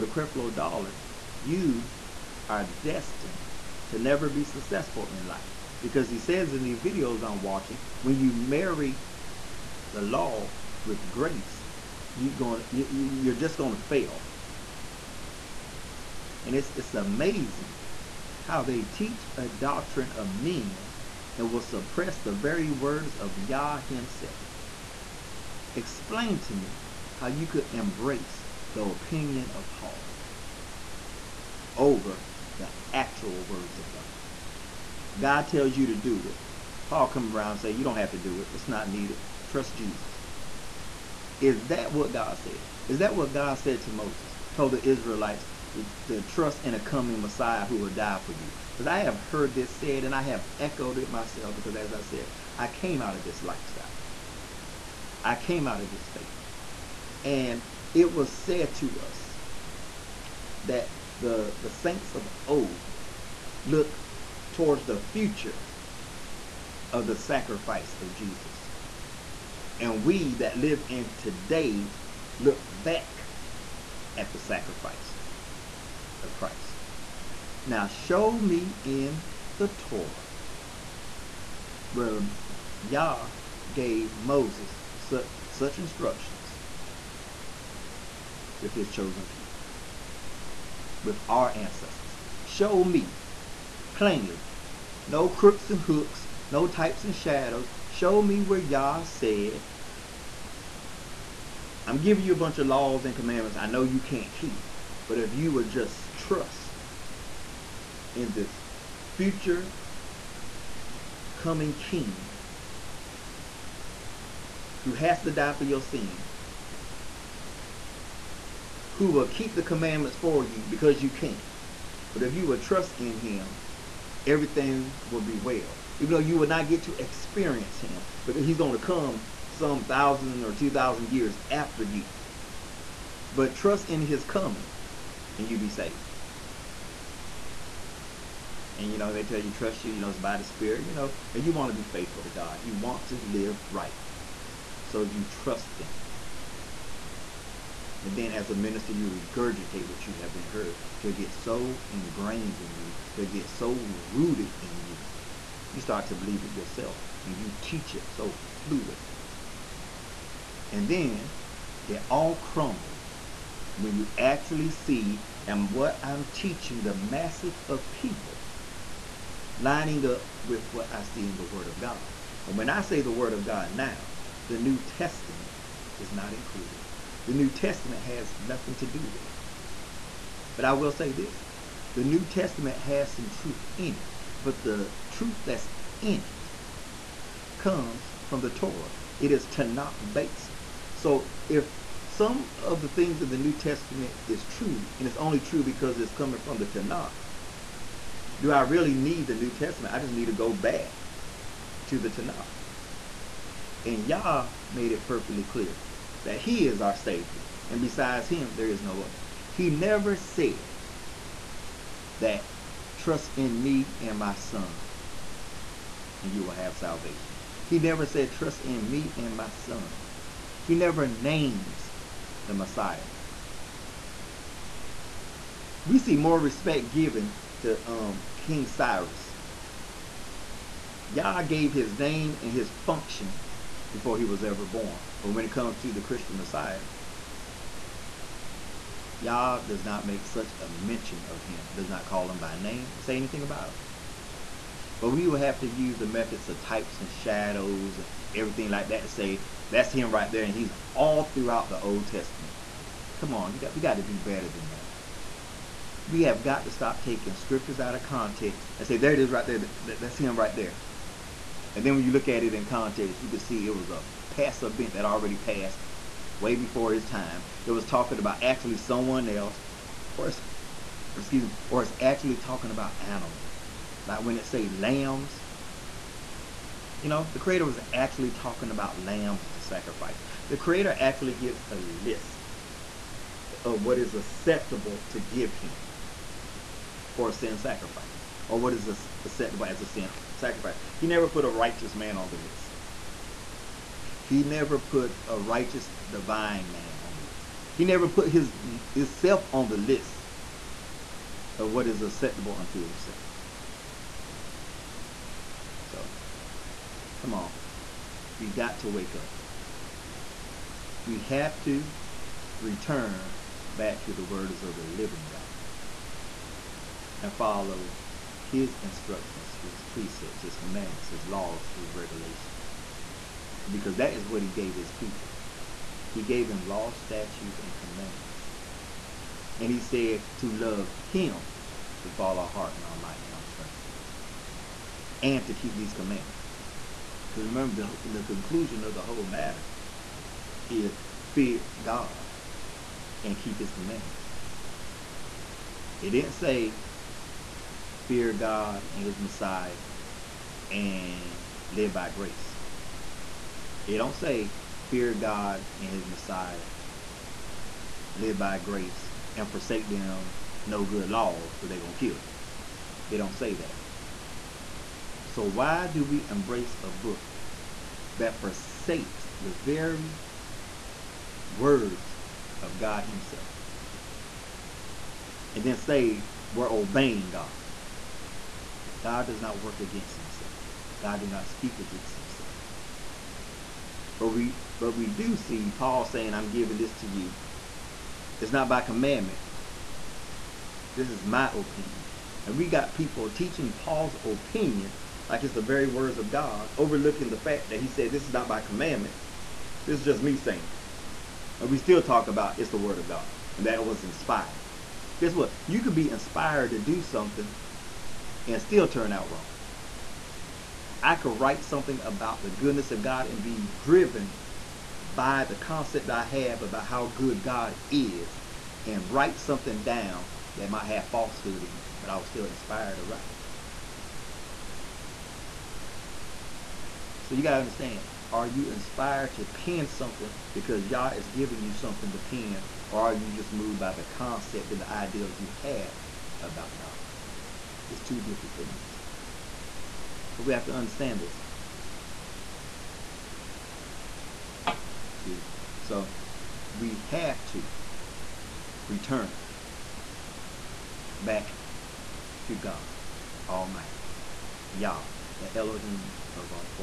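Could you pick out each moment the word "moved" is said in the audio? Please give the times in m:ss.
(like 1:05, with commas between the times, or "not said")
7:13.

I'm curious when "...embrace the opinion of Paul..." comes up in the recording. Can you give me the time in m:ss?
0:27.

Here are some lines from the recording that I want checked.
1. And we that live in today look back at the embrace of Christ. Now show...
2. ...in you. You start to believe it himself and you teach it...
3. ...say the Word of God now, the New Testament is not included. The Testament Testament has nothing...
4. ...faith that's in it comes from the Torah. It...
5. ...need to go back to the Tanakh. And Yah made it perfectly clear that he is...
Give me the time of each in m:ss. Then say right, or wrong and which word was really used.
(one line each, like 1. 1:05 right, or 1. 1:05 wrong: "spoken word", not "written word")
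1. 1:09 wrong: "sacrifice", not "embrace"
2. 2:34 wrong: "yourself", not "himself"
3. 2:52 wrong: "New", not "Testament"
4. 3:05 wrong: "truth", not "faith"
5. 3:20 right.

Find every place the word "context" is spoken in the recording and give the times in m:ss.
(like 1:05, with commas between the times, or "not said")
4:18, 4:22.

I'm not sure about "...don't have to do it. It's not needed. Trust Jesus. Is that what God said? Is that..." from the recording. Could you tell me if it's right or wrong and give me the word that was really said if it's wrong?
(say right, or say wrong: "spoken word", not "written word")
right.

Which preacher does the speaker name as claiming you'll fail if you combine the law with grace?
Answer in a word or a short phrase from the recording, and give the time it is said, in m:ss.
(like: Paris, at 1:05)
Creflo Dollar, at 0:00.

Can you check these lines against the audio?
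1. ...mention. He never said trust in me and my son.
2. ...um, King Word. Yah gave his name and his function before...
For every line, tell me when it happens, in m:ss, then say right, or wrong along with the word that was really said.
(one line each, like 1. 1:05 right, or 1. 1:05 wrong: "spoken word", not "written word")
1. 3:36 wrong: "salvation", not "mention"
2. 3:47 wrong: "Cyrus", not "Word".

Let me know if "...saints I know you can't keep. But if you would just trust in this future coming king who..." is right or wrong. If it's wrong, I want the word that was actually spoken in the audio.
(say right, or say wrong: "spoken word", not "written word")
wrong: "commandments", not "saints".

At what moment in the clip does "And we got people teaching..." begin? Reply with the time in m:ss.
6:32.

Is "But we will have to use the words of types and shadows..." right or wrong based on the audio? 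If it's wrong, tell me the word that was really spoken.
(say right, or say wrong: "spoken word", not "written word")
wrong: "methods", not "words".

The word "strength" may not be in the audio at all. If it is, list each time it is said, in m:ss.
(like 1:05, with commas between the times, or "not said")
5:33.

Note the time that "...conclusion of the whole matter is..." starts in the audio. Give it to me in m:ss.
5:38.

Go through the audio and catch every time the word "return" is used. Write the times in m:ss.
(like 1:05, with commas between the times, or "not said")
5:12, 7:28.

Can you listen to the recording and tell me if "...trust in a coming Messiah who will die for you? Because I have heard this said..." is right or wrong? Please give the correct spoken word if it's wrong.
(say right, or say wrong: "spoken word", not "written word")
right.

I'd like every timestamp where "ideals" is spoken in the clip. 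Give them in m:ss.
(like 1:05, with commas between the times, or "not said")
7:14.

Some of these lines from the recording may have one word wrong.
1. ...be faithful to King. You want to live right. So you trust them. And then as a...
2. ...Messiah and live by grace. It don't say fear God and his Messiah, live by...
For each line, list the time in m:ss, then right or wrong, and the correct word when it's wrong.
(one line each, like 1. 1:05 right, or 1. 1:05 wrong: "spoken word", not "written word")
1. 2:21 wrong: "God", not "King"
2. 5:49 right.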